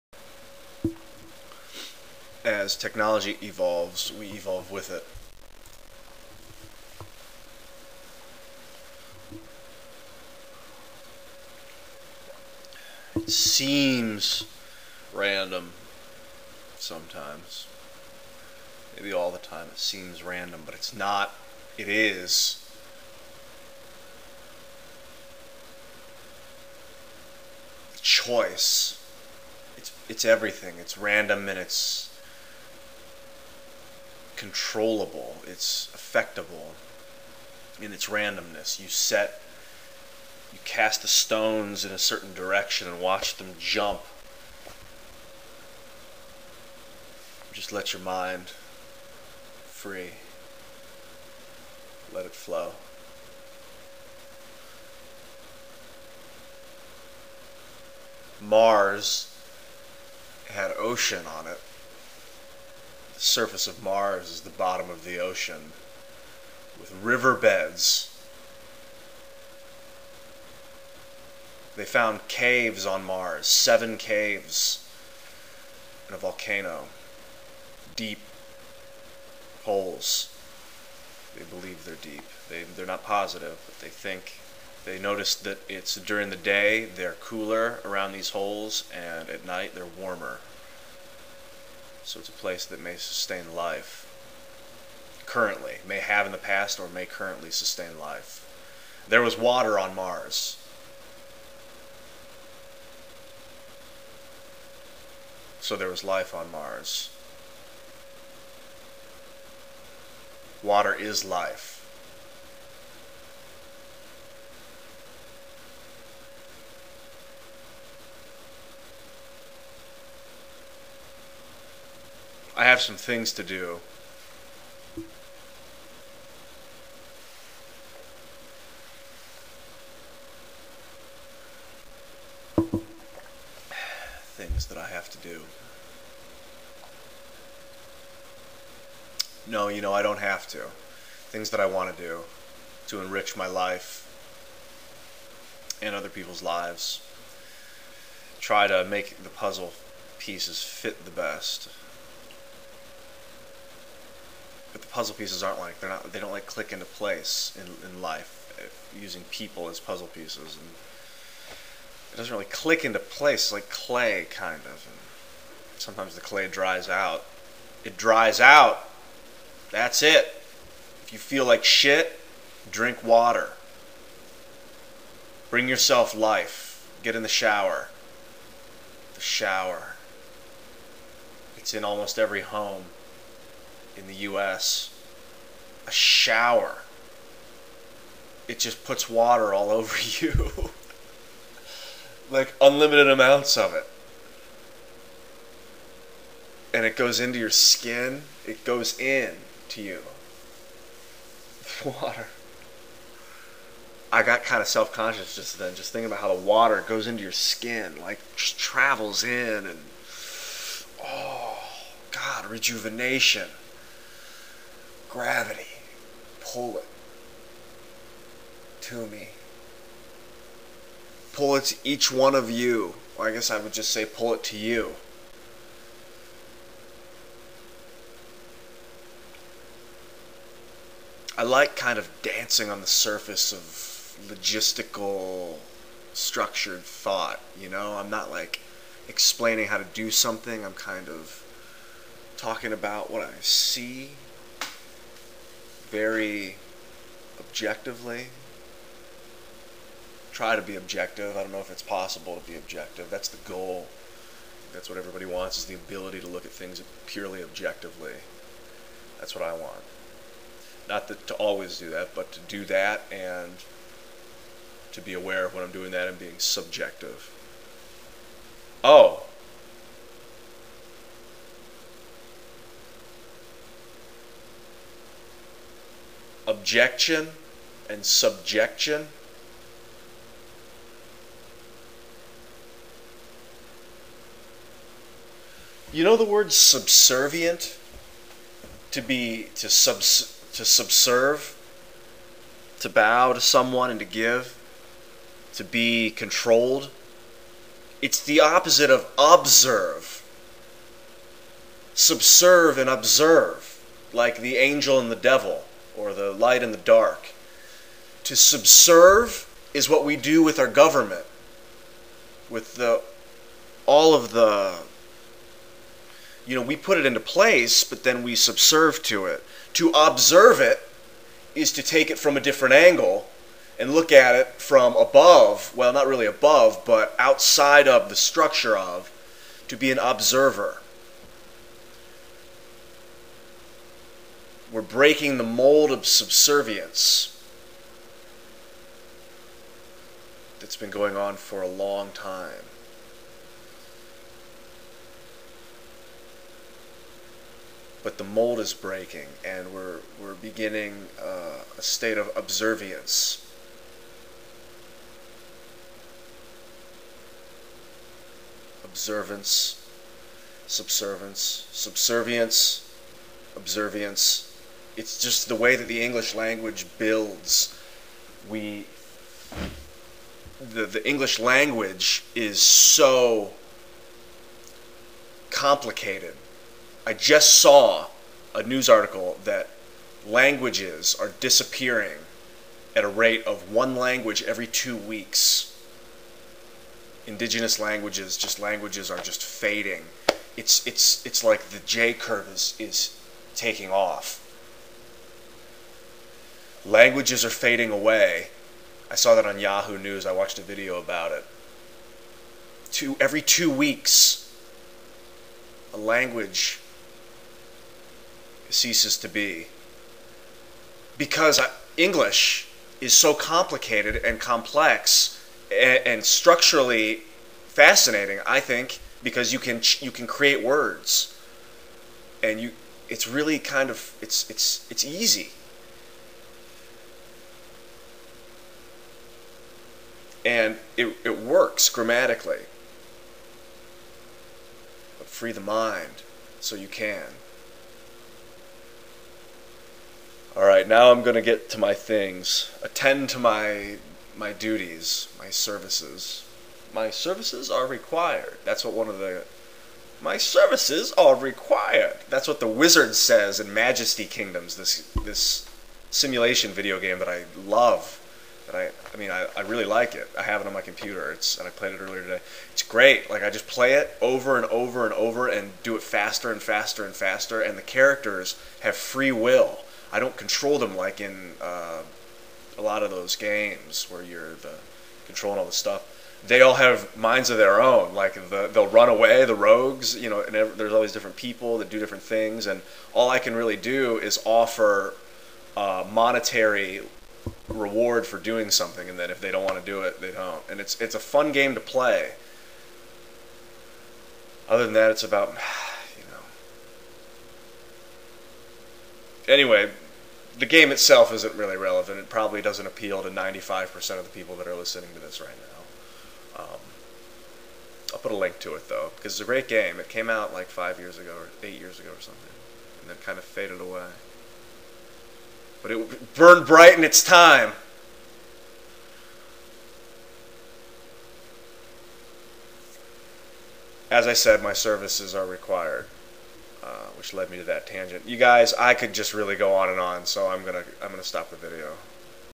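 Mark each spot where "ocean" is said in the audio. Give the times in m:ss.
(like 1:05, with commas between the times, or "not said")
1:00, 1:05.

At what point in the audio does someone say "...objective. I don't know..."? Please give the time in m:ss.
4:10.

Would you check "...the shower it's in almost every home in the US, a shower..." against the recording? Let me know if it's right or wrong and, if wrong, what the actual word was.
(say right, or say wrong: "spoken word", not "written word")
right.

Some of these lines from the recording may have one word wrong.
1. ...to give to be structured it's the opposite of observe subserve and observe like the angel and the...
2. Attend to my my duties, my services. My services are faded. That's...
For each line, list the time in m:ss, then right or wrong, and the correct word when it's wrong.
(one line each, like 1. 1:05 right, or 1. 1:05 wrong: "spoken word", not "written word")
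1. 4:53 wrong: "controlled", not "structured"
2. 7:22 wrong: "required", not "faded".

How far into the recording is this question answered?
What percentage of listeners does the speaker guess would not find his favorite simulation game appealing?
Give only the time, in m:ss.
8:23.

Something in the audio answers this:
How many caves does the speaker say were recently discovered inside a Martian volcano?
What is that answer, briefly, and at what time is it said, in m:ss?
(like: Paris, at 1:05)
7, at 1:13.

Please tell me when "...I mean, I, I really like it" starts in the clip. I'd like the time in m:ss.
7:39.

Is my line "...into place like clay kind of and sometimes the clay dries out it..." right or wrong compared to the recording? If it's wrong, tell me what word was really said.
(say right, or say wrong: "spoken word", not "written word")
right.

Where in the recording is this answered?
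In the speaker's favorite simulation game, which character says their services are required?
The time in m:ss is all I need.
7:32.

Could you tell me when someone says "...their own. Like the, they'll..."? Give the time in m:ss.
7:57.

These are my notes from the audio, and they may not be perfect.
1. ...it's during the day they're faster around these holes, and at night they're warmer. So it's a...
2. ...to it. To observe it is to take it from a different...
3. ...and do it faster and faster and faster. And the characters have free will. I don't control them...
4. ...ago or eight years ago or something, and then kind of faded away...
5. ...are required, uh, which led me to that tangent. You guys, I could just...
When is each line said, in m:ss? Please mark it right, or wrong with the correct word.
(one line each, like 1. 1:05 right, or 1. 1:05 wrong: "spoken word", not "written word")
1. 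1:25 wrong: "cooler", not "faster"
2. 5:19 right
3. 7:45 right
4. 8:31 right
5. 8:45 right.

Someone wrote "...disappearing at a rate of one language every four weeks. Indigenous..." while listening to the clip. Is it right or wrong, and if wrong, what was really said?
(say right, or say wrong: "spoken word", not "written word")
wrong: "two", not "four".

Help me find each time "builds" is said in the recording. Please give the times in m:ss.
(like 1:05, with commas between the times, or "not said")
6:06.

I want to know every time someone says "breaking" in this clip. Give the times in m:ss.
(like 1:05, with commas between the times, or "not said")
5:34, 5:48.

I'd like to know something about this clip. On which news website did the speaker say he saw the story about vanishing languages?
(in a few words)
Yahoo News.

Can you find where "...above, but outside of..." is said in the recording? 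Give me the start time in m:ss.
5:26.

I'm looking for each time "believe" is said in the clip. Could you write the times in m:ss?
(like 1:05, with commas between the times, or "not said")
1:21.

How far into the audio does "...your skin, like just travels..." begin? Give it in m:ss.
3:27.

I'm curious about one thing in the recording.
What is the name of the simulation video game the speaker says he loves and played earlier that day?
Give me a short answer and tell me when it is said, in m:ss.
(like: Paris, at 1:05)
Majesty Kingdoms, at 7:33.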